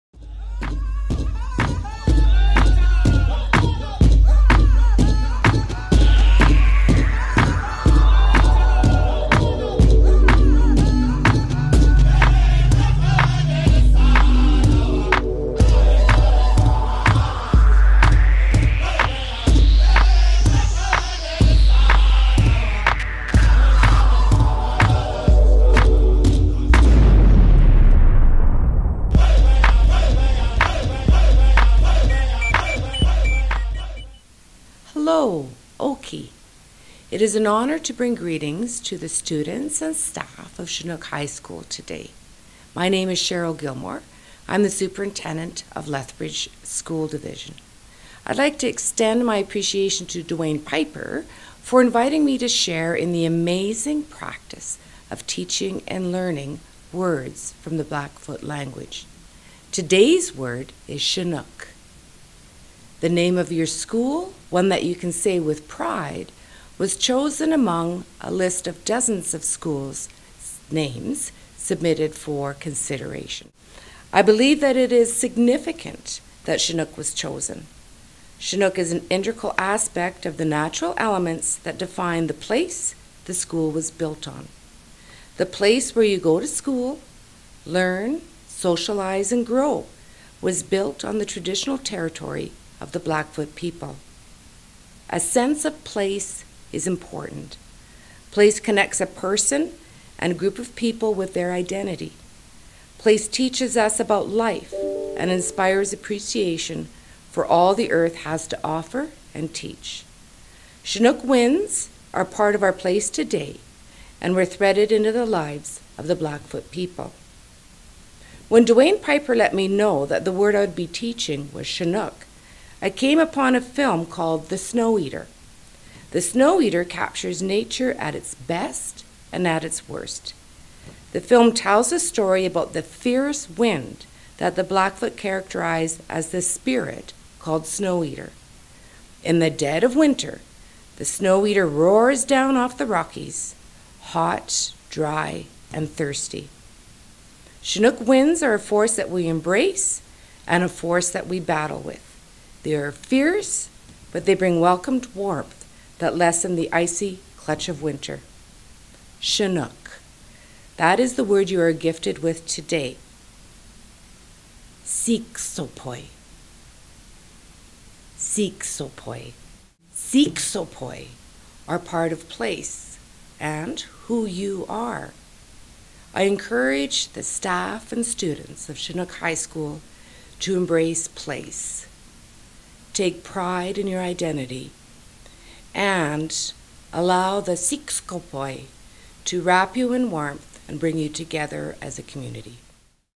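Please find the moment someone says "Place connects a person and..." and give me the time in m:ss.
1:38.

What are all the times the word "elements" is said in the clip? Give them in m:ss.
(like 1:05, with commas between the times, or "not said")
1:20.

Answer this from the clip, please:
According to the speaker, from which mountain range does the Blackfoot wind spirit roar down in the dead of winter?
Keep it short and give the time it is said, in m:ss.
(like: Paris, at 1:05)
the Rockies, at 2:22.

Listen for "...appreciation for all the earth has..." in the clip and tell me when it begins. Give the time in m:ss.
1:45.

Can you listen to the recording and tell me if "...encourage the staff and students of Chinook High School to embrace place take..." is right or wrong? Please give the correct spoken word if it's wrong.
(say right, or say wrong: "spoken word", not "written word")
right.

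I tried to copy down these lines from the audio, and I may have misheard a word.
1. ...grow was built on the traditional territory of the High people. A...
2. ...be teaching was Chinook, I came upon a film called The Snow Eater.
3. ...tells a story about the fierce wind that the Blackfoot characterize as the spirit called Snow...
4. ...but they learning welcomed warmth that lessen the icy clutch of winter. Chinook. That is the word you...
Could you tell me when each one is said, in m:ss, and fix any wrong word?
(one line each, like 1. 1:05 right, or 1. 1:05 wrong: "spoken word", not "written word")
1. 1:29 wrong: "Blackfoot", not "High"
2. 2:00 right
3. 2:11 right
4. 2:34 wrong: "bring", not "learning".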